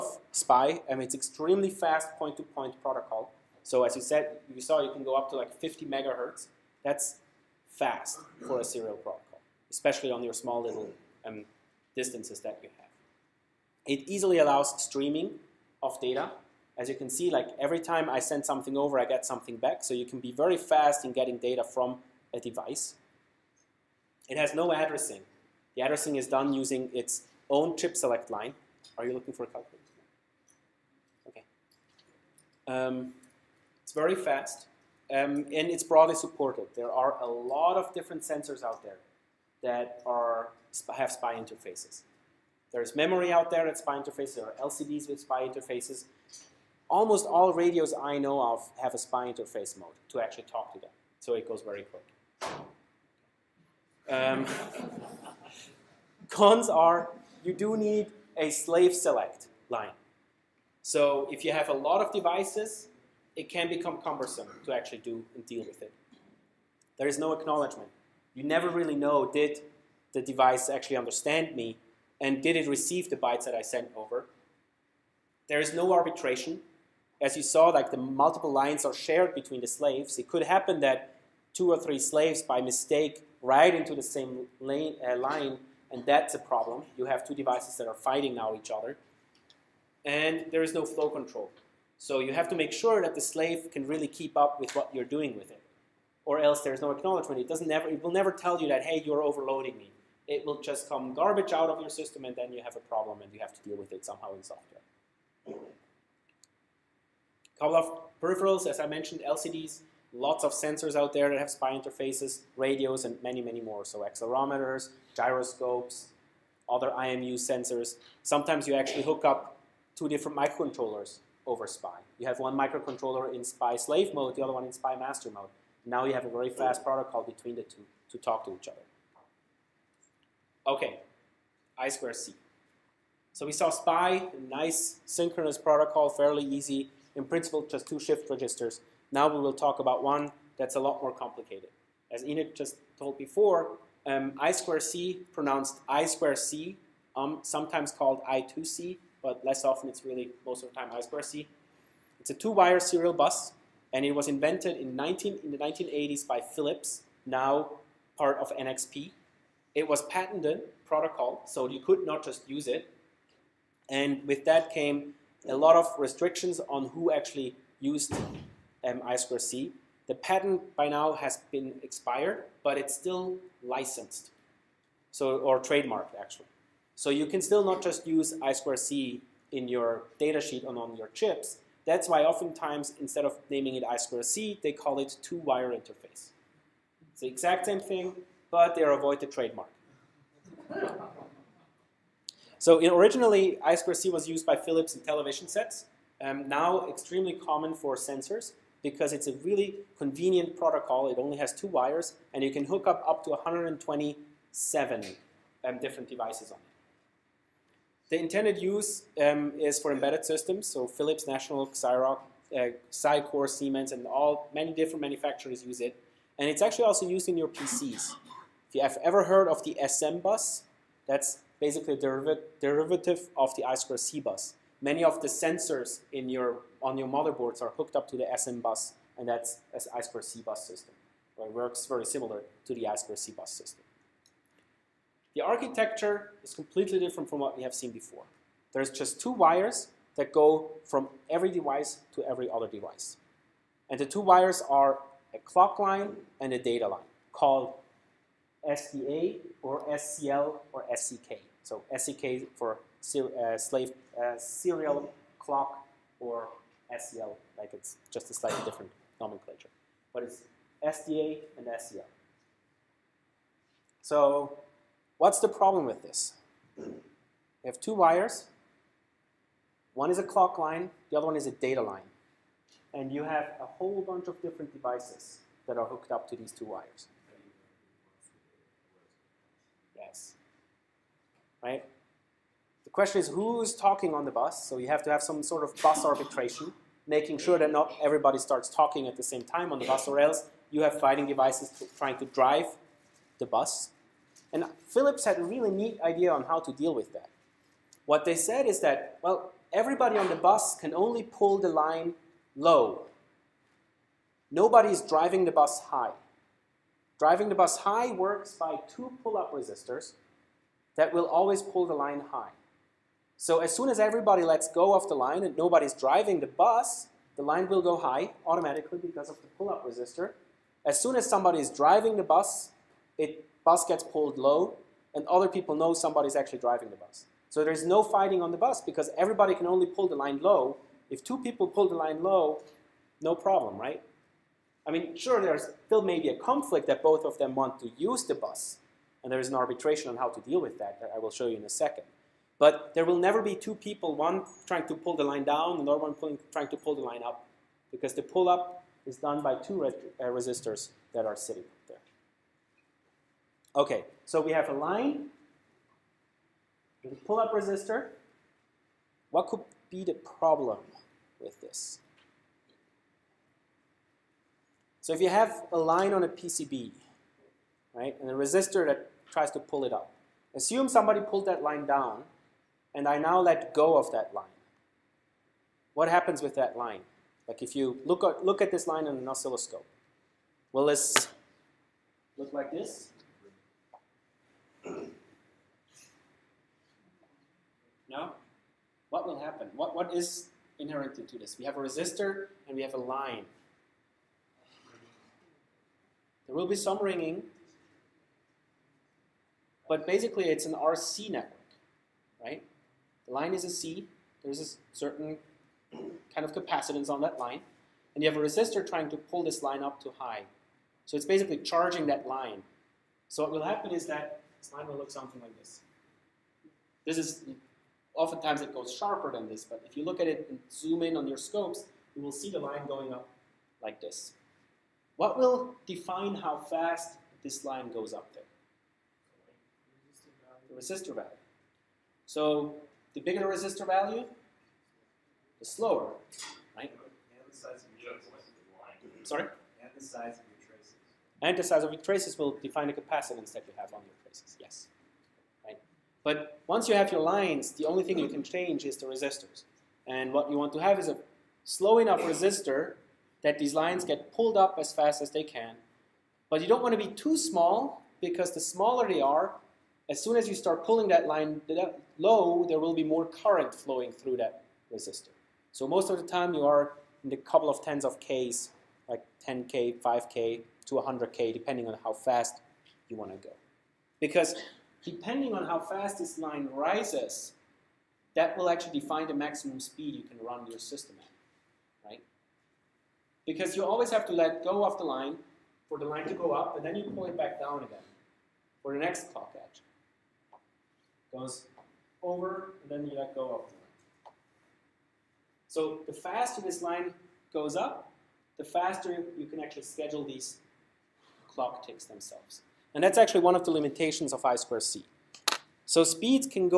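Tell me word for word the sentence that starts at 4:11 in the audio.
So SCK for uh, slave uh, serial clock or SCL, like it's just a slightly different nomenclature.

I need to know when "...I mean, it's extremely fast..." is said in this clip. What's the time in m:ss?
0:00.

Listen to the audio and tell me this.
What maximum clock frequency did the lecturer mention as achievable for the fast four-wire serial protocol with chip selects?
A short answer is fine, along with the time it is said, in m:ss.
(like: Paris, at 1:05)
50 MHz, at 0:05.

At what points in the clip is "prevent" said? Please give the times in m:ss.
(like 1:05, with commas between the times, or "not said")
not said.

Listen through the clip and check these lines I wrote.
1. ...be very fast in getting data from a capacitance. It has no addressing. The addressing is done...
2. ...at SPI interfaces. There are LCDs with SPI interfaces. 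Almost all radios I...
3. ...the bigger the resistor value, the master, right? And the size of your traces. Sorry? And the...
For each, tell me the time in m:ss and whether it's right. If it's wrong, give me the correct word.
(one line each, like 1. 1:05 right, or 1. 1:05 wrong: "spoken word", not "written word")
1. 0:20 wrong: "device", not "capacitance"
2. 0:43 right
3. 7:13 wrong: "slower", not "master".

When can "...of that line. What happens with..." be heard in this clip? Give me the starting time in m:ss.
6:13.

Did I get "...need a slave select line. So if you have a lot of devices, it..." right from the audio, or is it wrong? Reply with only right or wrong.
right.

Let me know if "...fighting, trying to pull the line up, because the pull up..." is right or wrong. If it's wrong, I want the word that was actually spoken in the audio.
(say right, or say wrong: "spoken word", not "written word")
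wrong: "pulling", not "fighting".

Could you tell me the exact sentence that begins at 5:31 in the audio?
If two people pull the line low, no problem, right?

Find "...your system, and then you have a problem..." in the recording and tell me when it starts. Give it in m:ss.
1:41.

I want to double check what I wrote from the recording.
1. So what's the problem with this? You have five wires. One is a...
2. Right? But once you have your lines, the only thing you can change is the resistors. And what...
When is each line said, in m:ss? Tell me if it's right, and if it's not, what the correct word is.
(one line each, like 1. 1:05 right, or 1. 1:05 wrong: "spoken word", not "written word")
1. 4:24 wrong: "two", not "five"
2. 7:25 right.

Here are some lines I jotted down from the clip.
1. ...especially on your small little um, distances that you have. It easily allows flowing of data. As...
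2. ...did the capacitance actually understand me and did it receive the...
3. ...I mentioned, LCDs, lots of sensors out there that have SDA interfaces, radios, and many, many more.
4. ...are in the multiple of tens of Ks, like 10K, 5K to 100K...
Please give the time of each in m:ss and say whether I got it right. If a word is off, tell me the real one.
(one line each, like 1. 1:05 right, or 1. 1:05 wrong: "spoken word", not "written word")
1. 0:09 wrong: "streaming", not "flowing"
2. 1:09 wrong: "device", not "capacitance"
3. 1:48 wrong: "SPI", not "SDA"
4. 7:46 wrong: "couple", not "multiple".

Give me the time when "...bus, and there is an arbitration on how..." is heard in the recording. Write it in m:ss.
5:38.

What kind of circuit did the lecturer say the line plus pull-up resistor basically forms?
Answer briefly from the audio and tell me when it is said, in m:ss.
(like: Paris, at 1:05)
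RC network, at 6:40.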